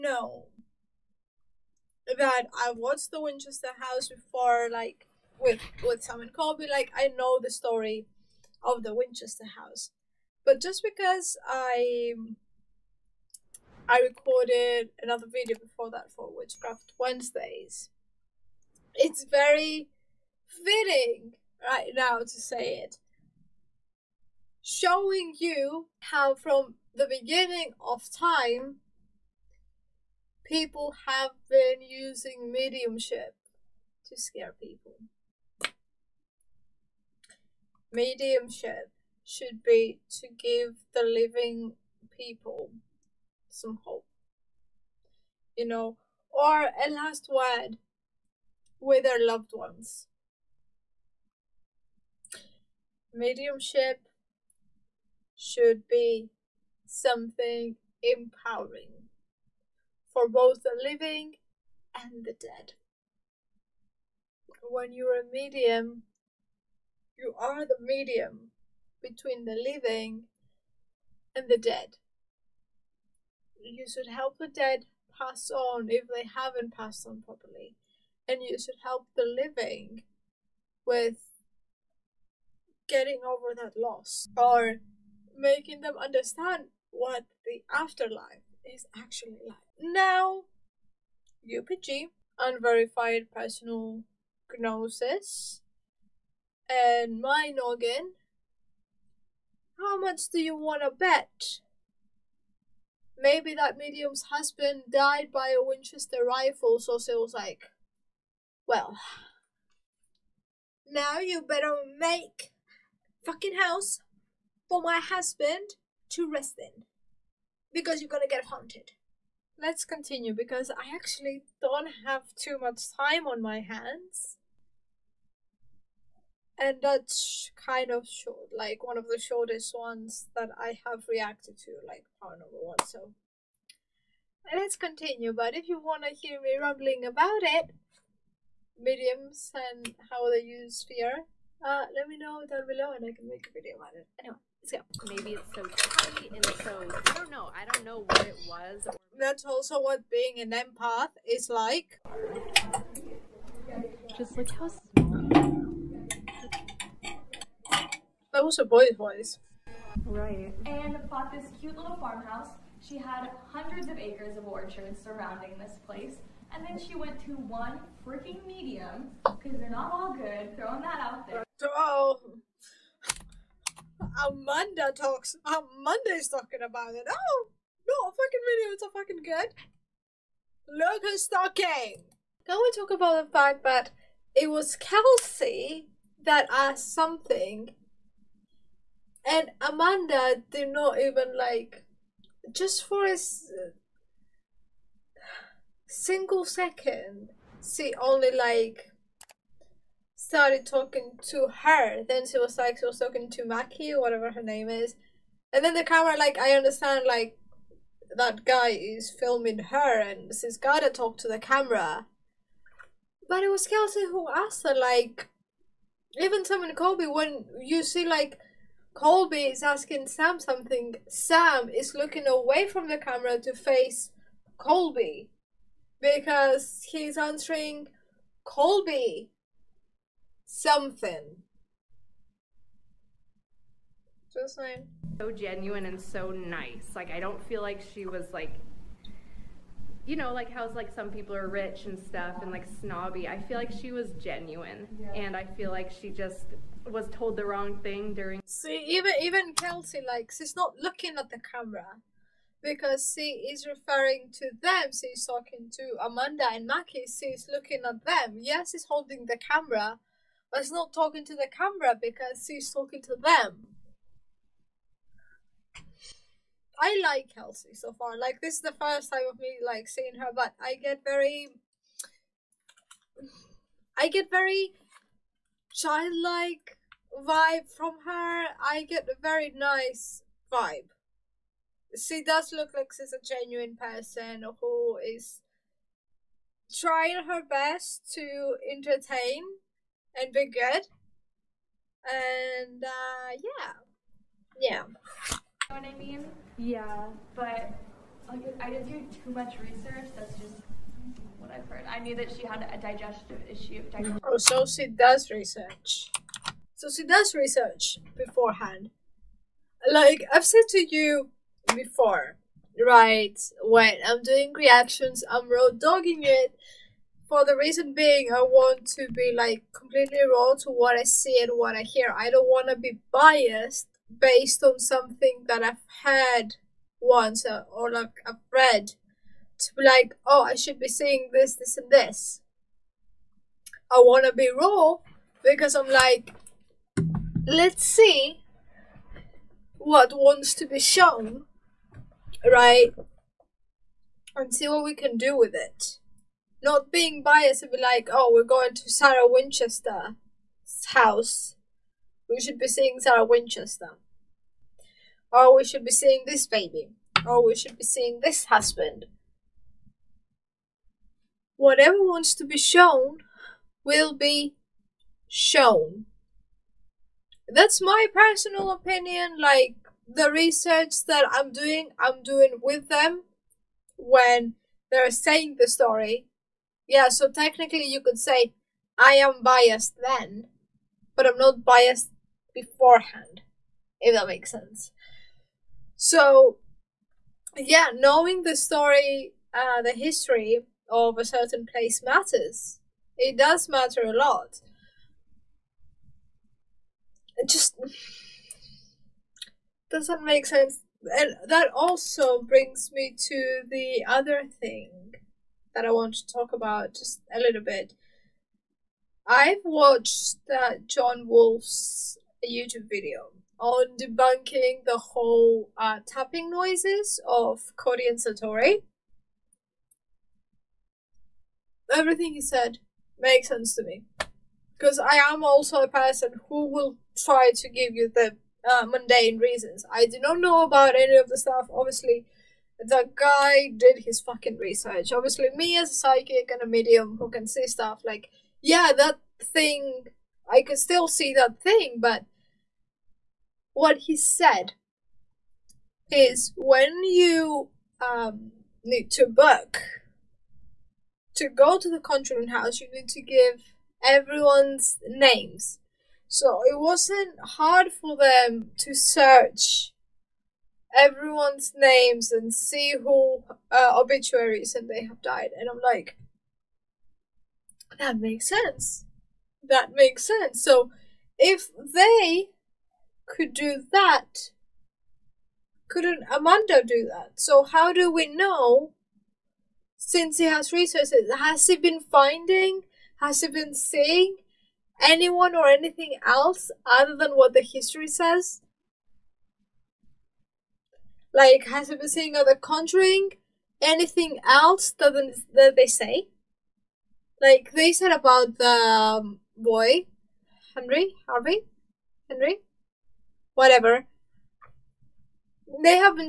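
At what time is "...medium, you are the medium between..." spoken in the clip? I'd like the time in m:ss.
1:05.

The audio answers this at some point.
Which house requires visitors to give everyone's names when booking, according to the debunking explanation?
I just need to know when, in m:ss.
7:31.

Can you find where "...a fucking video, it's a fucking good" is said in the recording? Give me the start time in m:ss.
2:58.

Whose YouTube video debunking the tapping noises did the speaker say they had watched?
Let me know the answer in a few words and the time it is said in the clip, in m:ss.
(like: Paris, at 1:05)
John Wolfe, at 6:50.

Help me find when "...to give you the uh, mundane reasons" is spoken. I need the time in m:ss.
7:07.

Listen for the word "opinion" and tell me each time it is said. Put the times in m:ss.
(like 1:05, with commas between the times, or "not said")
6:08.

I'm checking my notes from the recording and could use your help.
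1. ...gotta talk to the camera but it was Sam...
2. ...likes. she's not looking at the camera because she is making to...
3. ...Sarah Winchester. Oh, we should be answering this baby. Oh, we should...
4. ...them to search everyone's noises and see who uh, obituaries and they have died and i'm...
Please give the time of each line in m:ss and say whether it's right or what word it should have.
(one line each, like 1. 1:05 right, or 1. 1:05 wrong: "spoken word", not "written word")
1. 3:30 wrong: "Kelsi", not "Sam"
2. 4:10 wrong: "referring", not "making"
3. 5:52 wrong: "seeing", not "answering"
4. 7:38 wrong: "names", not "noises".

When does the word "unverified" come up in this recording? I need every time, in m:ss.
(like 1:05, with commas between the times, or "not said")
1:32.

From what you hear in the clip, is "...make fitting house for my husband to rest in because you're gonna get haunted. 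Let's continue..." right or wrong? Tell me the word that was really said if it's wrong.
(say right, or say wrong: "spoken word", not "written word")
wrong: "fucking", not "fitting".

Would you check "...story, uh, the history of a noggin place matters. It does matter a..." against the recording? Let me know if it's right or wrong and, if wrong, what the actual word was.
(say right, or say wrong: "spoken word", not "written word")
wrong: "certain", not "noggin".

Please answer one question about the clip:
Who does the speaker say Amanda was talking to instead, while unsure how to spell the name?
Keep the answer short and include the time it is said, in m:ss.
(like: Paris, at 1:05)
Maki, at 3:23.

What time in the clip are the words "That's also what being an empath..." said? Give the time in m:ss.
2:29.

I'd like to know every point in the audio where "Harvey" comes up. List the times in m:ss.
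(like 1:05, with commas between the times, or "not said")
8:21.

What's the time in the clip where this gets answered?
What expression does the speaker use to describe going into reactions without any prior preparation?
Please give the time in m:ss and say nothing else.
5:15.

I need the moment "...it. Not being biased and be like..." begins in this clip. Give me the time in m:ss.
5:45.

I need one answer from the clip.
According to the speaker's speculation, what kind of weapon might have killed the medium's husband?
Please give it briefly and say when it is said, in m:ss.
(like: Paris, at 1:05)
Winchester rifle, at 1:45.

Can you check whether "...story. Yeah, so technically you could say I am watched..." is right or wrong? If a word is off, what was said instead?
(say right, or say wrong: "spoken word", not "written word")
wrong: "biased", not "watched".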